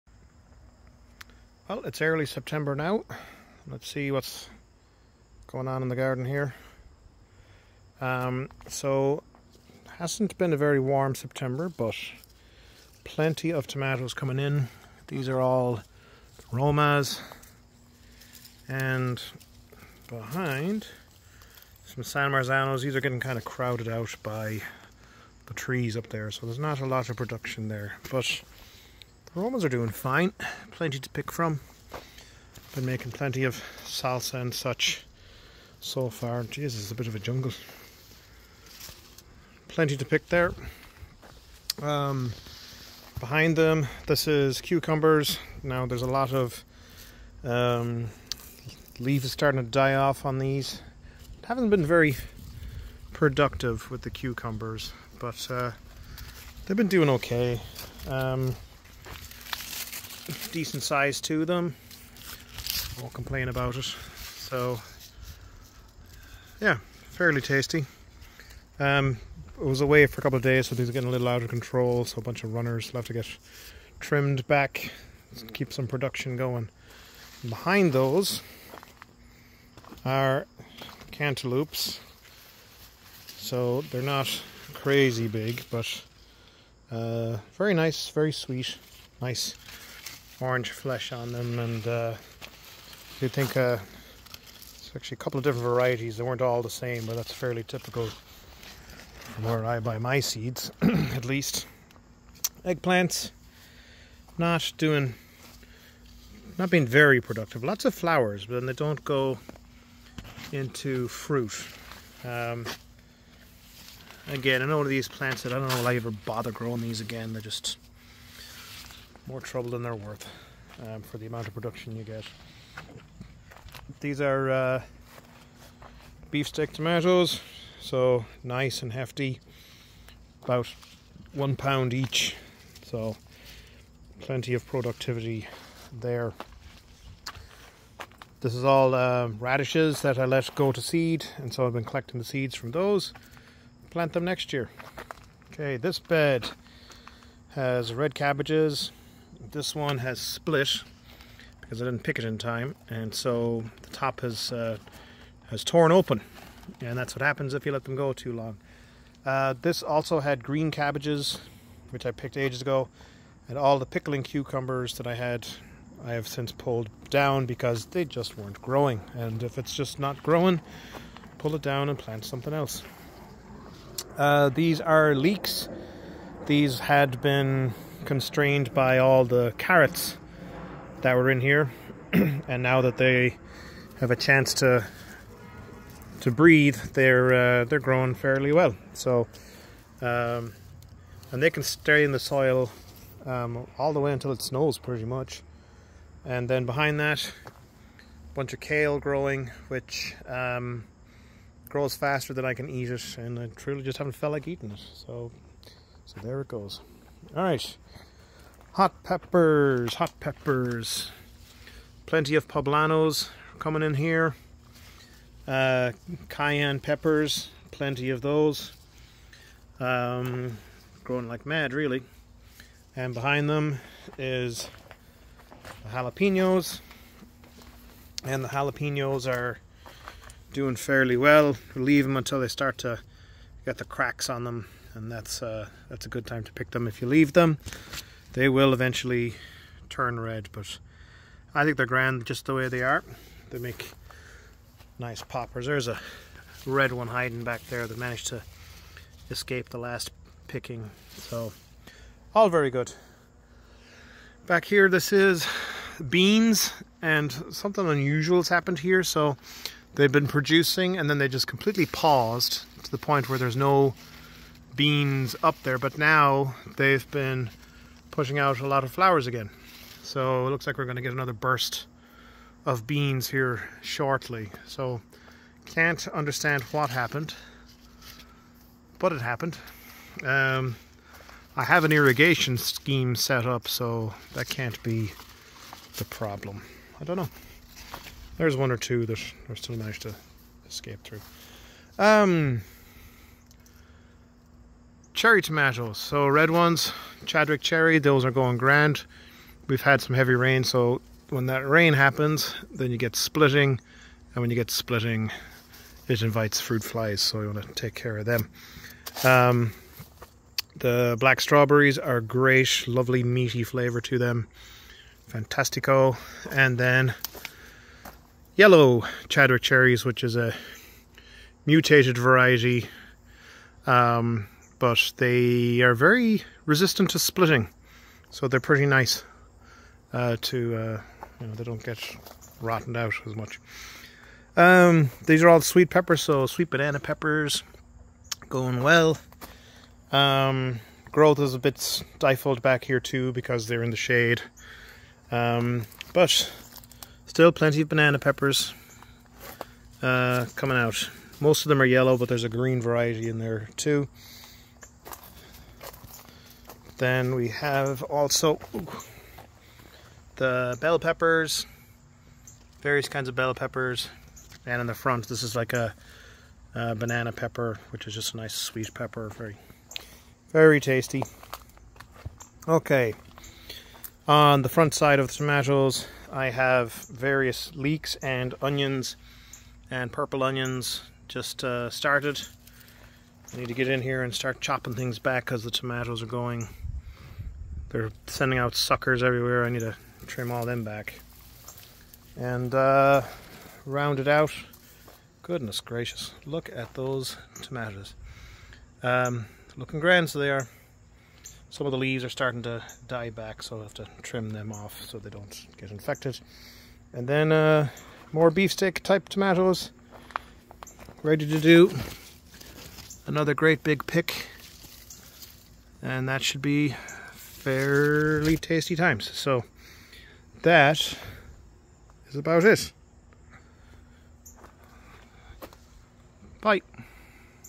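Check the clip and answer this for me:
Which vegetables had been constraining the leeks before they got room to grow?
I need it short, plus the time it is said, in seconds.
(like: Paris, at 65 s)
Carrots, at 179 s.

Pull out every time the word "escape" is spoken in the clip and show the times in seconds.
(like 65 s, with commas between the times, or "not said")
249 s, 290 s.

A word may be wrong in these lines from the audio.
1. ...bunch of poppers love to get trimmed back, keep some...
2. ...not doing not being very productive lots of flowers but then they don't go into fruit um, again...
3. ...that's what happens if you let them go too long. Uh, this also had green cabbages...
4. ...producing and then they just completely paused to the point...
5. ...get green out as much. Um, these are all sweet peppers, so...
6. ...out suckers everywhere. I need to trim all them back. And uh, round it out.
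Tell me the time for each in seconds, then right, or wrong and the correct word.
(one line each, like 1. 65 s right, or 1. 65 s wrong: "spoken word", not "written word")
1. 72 s wrong: "runners", not "poppers"
2. 104 s right
3. 156 s right
4. 260 s right
5. 331 s wrong: "rotten", not "green"
6. 388 s right.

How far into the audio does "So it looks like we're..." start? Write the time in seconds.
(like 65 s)
270 s.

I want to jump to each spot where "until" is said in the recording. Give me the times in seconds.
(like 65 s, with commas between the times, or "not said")
194 s, 232 s.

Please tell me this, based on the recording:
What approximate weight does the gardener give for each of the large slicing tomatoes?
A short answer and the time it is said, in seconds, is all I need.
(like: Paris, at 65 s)
1 pound, at 131 s.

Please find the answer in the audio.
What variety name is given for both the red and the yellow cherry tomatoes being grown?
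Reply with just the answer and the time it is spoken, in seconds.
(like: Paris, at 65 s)
Chadwick cherry, at 297 s.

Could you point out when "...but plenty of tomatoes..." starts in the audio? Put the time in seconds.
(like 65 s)
11 s.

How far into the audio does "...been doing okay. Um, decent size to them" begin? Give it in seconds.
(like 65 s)
56 s.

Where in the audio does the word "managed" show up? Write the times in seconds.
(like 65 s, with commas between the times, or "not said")
247 s, 289 s.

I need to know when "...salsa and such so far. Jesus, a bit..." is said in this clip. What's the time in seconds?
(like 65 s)
33 s.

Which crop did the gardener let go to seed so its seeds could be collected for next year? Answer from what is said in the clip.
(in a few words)
Radishes.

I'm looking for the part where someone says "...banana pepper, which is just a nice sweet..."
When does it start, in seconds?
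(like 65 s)
366 s.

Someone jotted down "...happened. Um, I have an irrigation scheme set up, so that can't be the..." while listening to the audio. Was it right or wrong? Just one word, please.
right.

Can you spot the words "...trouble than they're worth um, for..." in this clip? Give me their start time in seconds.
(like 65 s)
119 s.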